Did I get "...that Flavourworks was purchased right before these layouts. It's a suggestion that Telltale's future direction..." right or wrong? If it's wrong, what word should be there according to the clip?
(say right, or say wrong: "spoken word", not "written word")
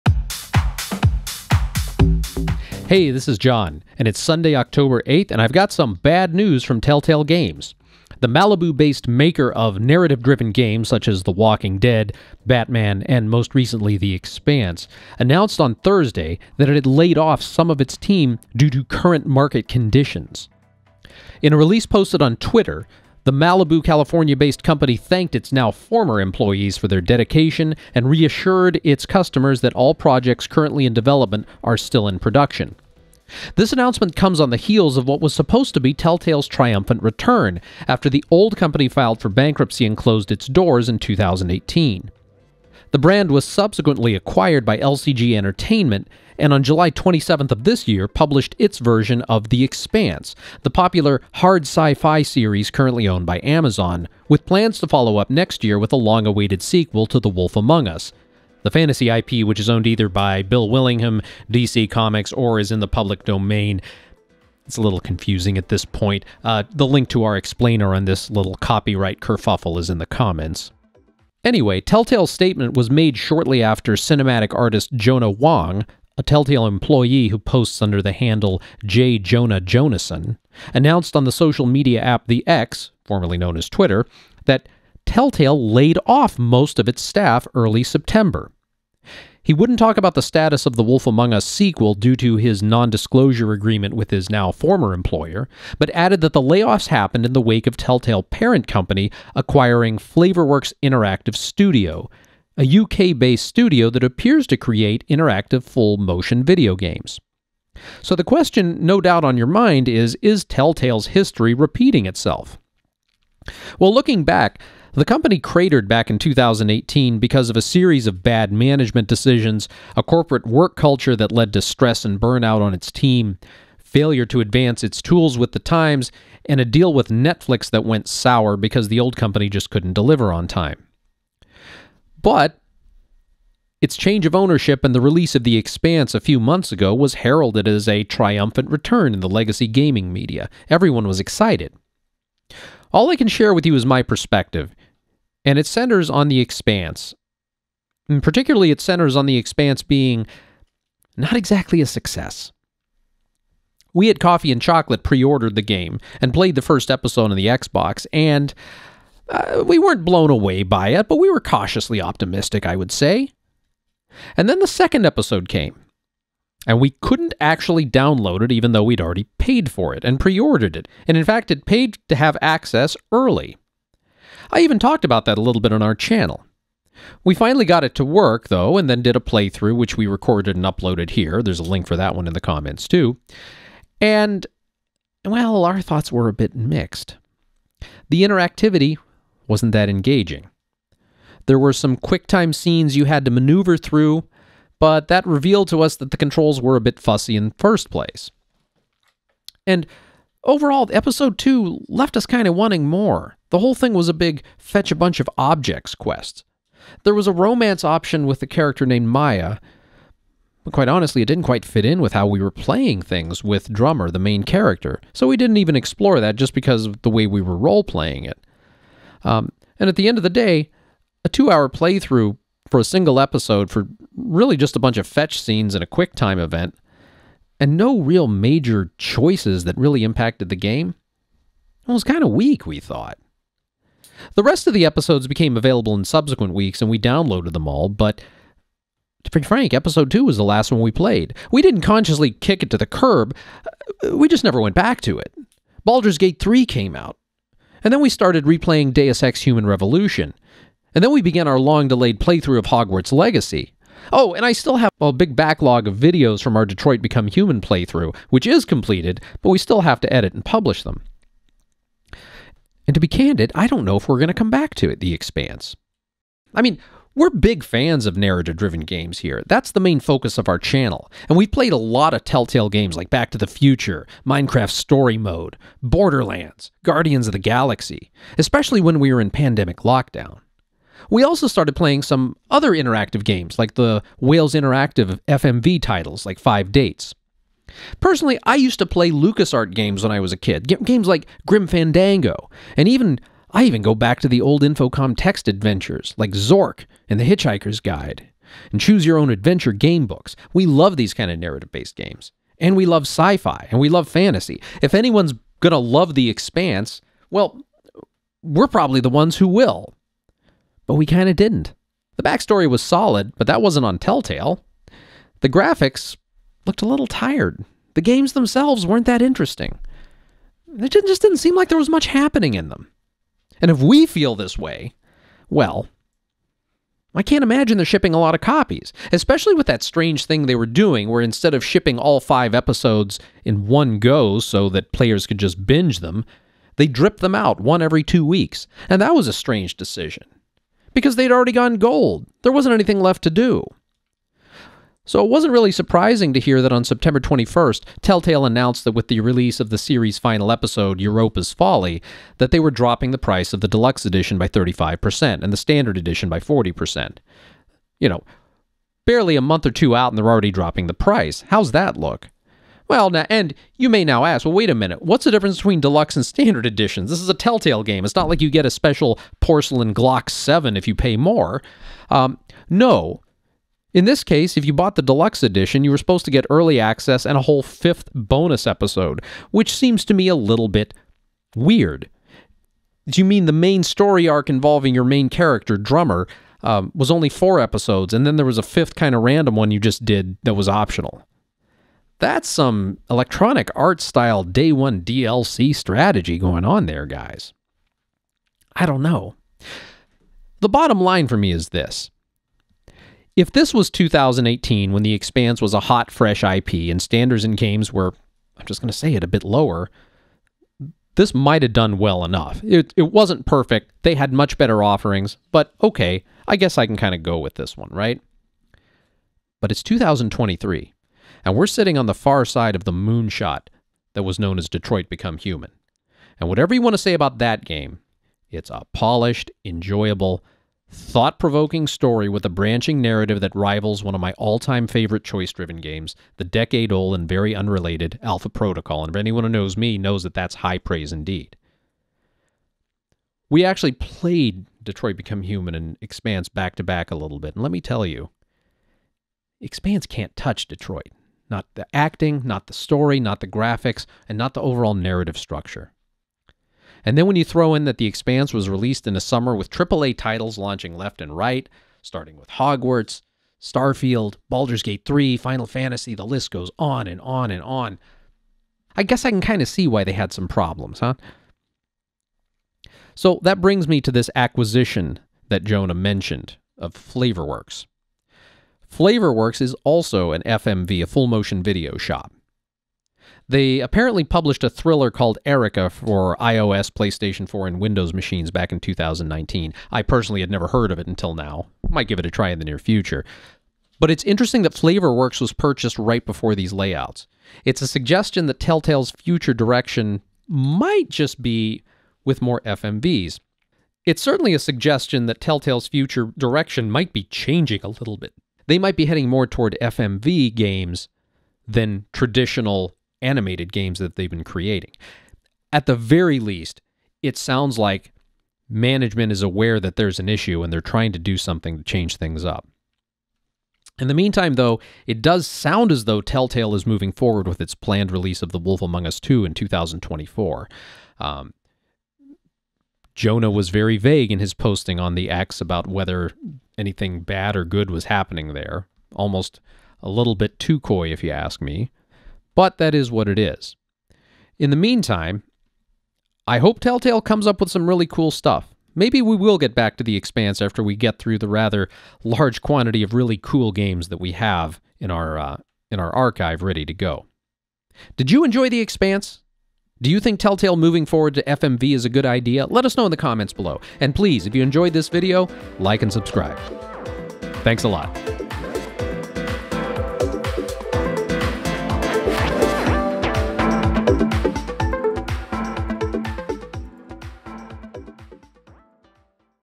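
right.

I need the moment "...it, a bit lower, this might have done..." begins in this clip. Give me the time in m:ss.
6:49.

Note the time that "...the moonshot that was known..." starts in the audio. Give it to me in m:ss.
7:02.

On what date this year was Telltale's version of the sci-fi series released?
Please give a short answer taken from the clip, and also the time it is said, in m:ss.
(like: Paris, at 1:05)
July 27th, at 0:46.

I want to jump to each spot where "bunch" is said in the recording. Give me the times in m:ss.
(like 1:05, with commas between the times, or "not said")
3:24, 3:44.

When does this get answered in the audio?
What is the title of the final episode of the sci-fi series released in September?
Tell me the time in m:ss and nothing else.
5:51.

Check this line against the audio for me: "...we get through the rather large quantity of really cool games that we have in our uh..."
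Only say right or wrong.
right.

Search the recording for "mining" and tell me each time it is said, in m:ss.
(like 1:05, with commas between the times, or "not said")
not said.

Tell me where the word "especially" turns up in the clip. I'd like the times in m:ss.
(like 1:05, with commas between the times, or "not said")
4:38, 5:29.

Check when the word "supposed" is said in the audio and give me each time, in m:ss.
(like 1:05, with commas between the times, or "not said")
0:35, 6:15.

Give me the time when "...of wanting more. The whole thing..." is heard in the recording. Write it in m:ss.
3:22.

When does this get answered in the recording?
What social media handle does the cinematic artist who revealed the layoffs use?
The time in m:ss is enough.
1:18.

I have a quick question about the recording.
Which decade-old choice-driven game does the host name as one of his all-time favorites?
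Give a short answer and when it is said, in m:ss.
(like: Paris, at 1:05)
Alpha Protocol, at 7:18.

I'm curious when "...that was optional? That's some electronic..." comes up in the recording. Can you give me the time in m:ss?
6:30.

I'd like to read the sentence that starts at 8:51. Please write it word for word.
Um, Jonah was very vague in his posting on the X about whether anything bad or good was happening there.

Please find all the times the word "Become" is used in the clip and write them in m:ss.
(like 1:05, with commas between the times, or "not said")
4:17, 7:05, 7:25.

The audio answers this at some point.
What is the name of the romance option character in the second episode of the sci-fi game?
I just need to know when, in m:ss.
3:29.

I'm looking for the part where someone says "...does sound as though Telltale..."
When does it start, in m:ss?
8:45.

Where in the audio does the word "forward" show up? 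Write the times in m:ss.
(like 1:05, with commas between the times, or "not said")
8:47, 9:21.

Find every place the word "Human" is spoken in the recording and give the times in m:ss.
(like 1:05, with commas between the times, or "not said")
4:09, 4:17, 7:05, 7:25.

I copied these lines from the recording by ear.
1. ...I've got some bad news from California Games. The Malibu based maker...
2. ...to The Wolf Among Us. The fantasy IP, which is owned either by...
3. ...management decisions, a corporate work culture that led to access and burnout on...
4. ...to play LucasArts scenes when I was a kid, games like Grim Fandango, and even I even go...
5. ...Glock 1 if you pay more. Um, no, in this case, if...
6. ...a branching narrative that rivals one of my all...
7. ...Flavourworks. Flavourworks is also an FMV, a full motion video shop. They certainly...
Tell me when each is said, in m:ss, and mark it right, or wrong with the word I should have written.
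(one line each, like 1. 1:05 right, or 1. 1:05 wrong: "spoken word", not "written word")
1. 0:05 wrong: "Telltale", not "California"
2. 0:57 right
3. 1:58 wrong: "stress", not "access"
4. 4:48 wrong: "games", not "scenes"
5. 6:09 wrong: "7", not "1"
6. 7:12 right
7. 7:56 wrong: "apparently", not "certainly".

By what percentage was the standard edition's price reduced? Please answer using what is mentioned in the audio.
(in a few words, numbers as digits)
40%.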